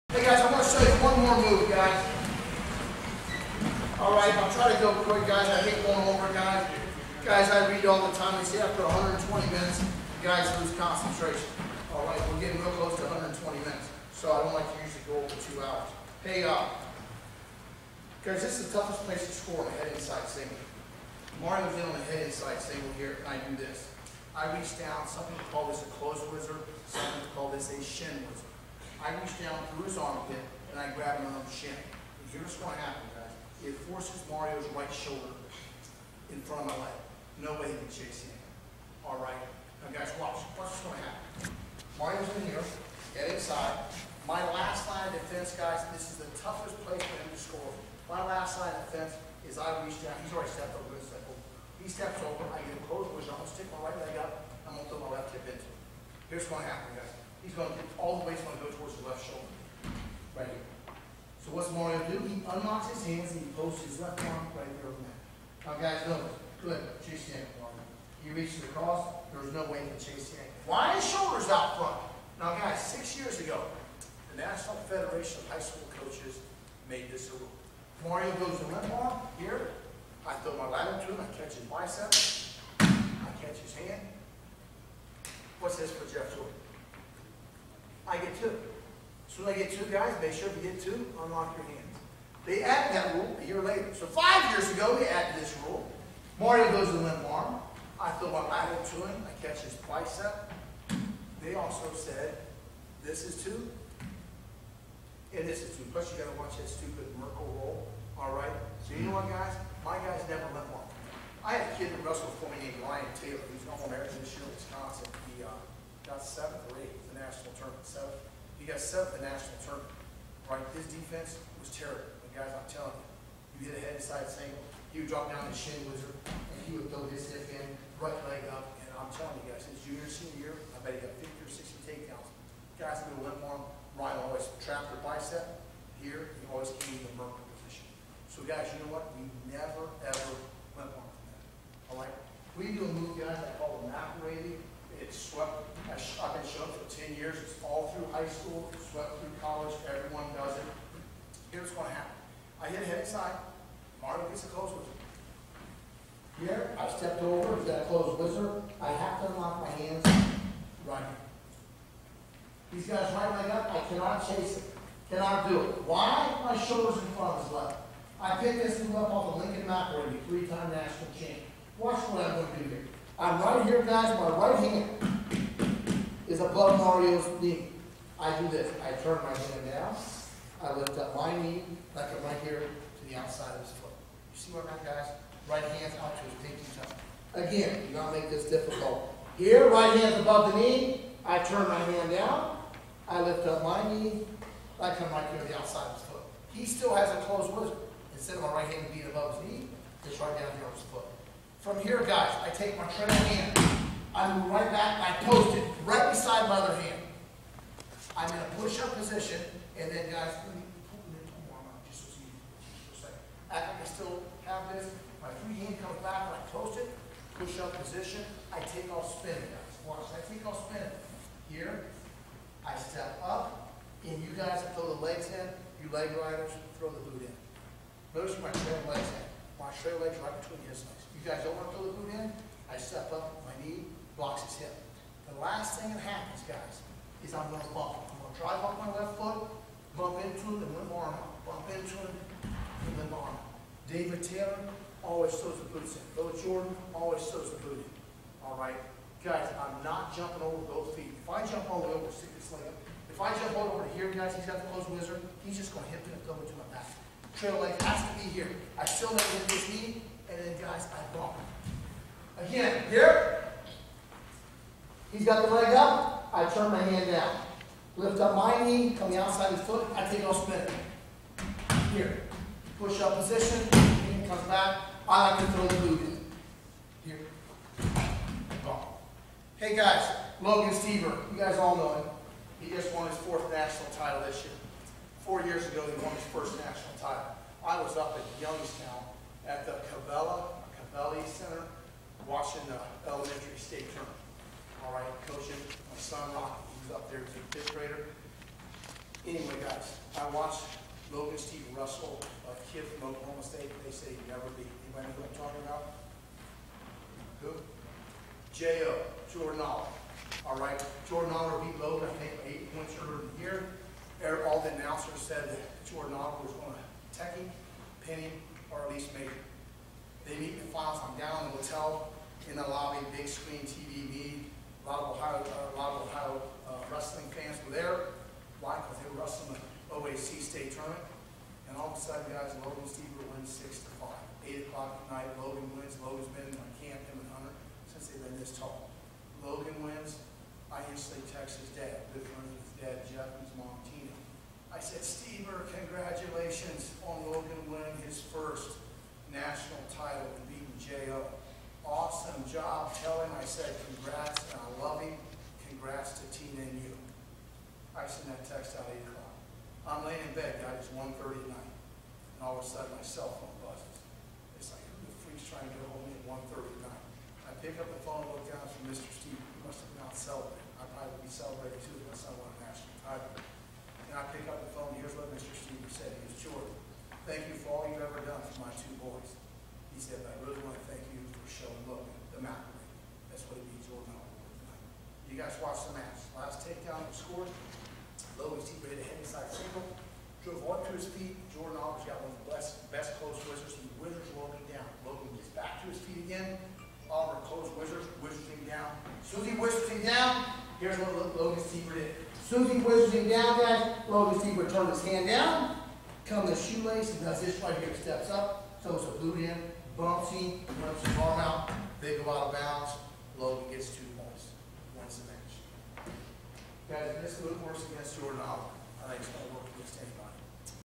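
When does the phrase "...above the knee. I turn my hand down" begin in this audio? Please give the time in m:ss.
3:10.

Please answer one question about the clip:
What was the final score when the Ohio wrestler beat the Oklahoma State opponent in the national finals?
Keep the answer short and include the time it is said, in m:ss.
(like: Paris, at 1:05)
6 to 5, at 5:33.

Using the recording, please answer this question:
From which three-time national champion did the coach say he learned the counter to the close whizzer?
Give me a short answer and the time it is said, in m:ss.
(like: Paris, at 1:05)
Lincoln McIlravy, at 2:49.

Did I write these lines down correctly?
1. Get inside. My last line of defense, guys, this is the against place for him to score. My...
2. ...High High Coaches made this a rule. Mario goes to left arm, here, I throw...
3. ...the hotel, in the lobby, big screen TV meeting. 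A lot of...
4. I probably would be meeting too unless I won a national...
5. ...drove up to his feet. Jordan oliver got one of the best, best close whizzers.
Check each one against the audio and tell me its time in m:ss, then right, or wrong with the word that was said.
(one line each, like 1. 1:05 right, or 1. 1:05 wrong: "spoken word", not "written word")
1. 0:43 wrong: "toughest", not "against"
2. 1:15 wrong: "School", not "High"
3. 5:21 right
4. 6:10 wrong: "celebrating", not "meeting"
5. 6:30 right.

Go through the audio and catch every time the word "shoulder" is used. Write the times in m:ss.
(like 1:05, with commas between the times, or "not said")
0:34, 0:59, 1:11, 2:46.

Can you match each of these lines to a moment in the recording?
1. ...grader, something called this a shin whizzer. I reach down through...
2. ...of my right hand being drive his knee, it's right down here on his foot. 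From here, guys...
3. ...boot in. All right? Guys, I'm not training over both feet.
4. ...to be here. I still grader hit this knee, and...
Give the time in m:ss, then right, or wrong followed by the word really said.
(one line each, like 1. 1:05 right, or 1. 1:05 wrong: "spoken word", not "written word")
1. 0:26 wrong: "whizzer", not "grader"
2. 3:18 wrong: "above", not "drive"
3. 4:07 wrong: "jumping", not "training"
4. 4:18 wrong: "never", not "grader".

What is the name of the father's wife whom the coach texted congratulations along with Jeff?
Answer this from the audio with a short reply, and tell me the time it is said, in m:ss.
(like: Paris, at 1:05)
Tina, at 5:43.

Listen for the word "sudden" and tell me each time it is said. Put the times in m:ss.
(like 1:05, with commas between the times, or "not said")
5:32, 6:02.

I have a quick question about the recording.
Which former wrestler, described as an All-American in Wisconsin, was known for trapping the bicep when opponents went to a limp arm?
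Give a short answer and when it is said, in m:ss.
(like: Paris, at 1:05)
Ryan Taylor, at 1:52.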